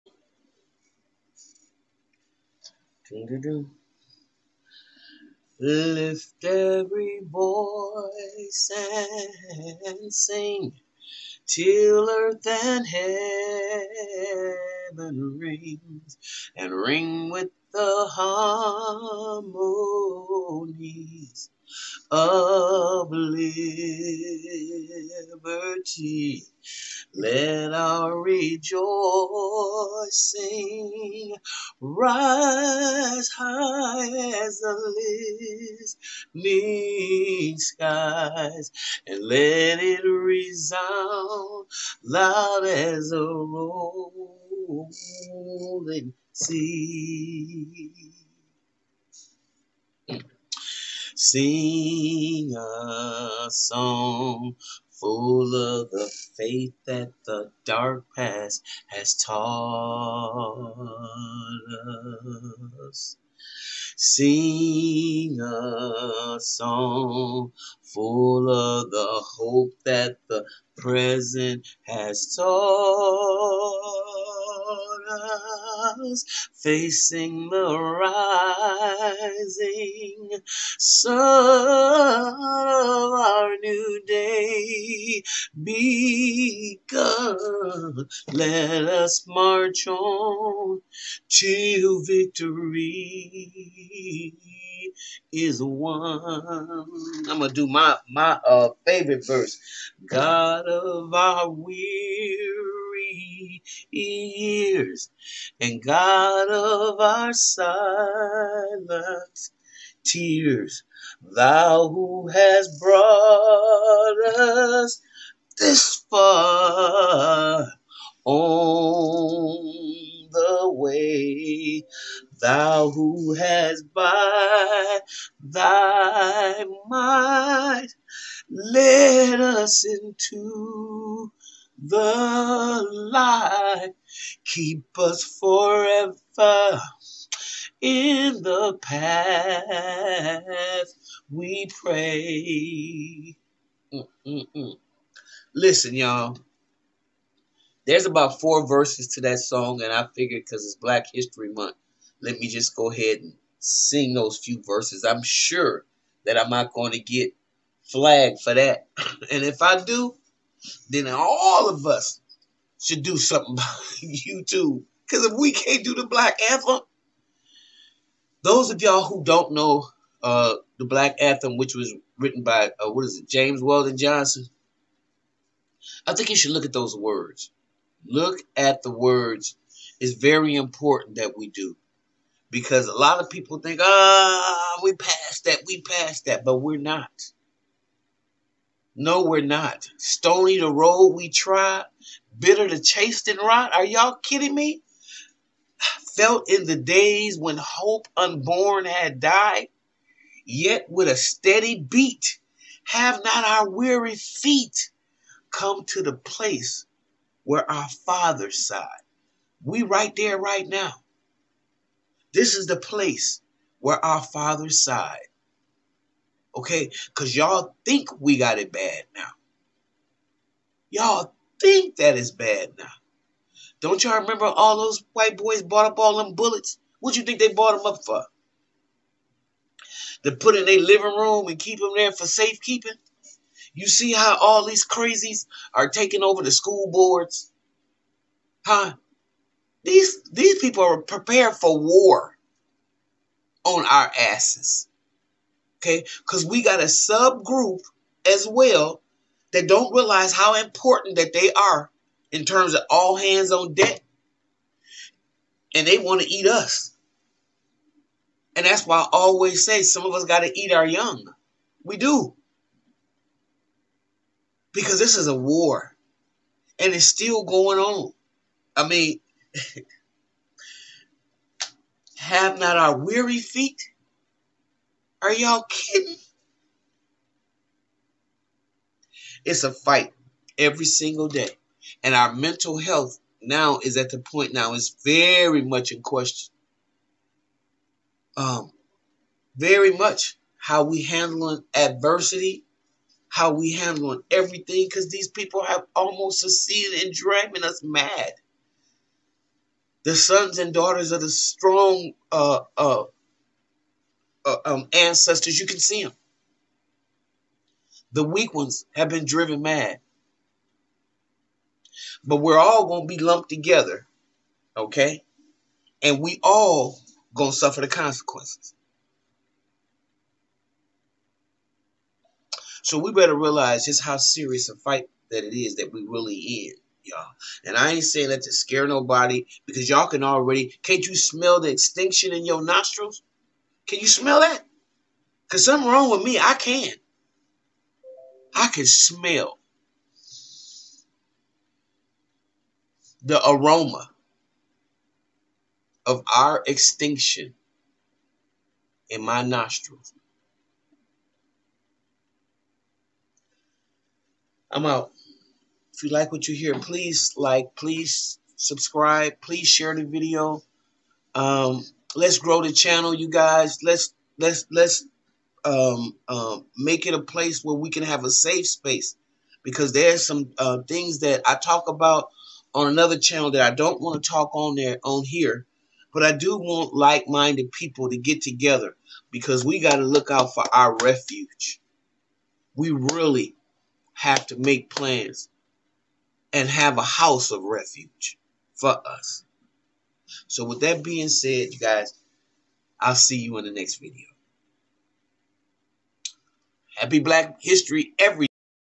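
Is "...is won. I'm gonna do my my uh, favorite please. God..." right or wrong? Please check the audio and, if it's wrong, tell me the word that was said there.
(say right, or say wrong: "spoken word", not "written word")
wrong: "verse", not "please".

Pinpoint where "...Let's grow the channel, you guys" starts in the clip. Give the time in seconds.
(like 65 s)
362 s.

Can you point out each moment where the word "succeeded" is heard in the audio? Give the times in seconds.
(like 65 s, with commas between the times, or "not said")
296 s.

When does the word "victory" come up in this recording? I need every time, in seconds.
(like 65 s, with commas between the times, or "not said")
92 s.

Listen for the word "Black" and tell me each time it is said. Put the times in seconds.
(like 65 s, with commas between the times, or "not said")
150 s, 166 s, 170 s, 397 s.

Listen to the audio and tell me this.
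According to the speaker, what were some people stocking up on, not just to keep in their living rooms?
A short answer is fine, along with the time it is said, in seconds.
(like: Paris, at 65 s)
bullets, at 226 s.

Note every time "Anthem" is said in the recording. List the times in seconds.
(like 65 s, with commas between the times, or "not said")
166 s, 171 s.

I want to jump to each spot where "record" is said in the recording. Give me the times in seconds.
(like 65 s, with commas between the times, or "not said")
not said.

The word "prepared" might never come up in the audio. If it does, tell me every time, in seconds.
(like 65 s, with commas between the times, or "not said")
241 s.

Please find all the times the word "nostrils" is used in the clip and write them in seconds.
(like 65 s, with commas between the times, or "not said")
332 s, 349 s.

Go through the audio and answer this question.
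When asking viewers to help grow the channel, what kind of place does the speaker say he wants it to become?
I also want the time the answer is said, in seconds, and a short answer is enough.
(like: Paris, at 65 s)
a safe space, at 368 s.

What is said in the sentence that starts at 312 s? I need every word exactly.
But we're all going to be lumped together, okay?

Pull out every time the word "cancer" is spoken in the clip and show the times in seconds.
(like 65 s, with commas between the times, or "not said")
not said.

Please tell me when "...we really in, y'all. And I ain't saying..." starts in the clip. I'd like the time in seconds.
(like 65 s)
325 s.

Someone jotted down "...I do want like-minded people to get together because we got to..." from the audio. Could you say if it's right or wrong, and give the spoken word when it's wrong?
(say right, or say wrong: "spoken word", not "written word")
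right.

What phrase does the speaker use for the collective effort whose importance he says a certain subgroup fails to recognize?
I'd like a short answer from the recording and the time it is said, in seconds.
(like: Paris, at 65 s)
all hands on deck, at 252 s.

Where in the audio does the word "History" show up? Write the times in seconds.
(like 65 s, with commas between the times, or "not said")
151 s, 397 s.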